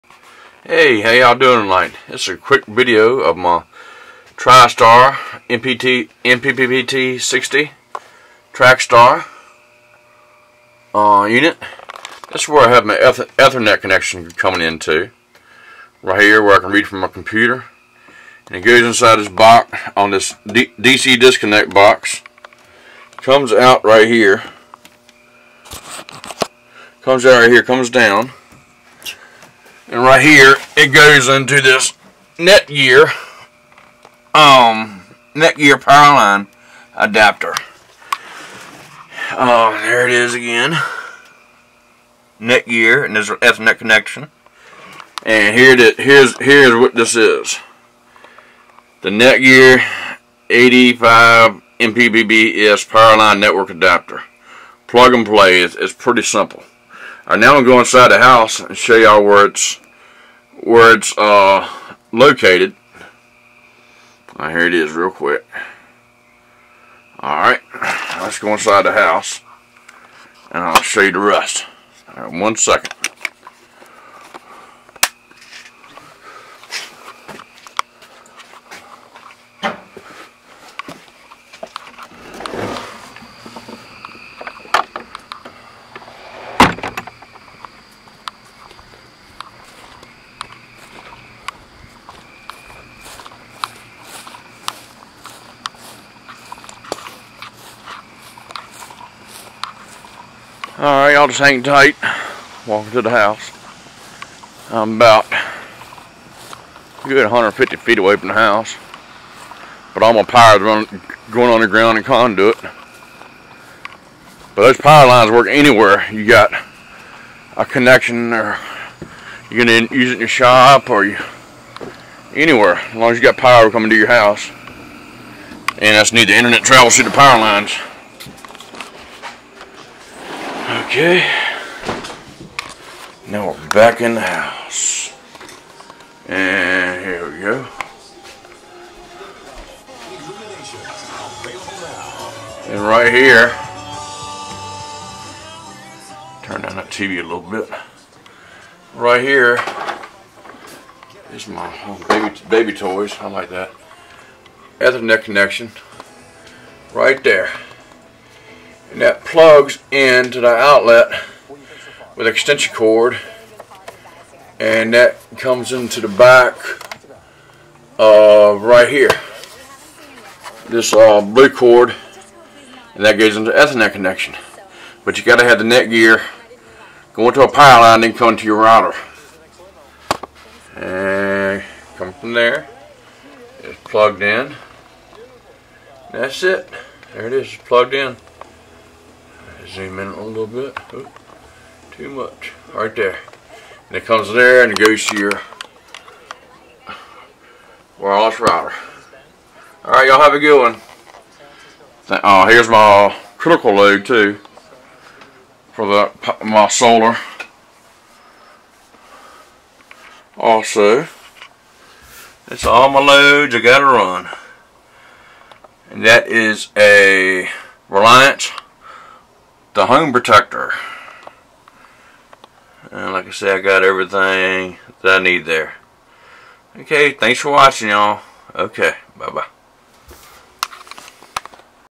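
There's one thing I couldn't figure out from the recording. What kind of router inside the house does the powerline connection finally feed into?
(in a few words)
Wireless router.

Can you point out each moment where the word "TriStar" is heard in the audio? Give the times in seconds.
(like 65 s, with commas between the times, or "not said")
4 s.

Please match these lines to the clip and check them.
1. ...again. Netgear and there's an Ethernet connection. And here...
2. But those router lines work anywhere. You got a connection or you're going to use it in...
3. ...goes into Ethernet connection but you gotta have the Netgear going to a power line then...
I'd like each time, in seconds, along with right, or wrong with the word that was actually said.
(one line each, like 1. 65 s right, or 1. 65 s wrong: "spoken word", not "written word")
1. 40 s right
2. 114 s wrong: "power", not "router"
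3. 173 s right.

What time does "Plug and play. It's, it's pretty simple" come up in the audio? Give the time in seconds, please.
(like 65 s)
54 s.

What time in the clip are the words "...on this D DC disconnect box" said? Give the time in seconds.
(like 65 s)
19 s.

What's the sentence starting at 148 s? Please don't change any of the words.
Right here is my baby baby toys.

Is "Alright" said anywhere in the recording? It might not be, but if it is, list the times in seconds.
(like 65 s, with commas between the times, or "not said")
67 s, 100 s, 199 s.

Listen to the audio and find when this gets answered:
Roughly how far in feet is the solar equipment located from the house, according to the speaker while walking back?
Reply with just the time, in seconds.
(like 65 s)
107 s.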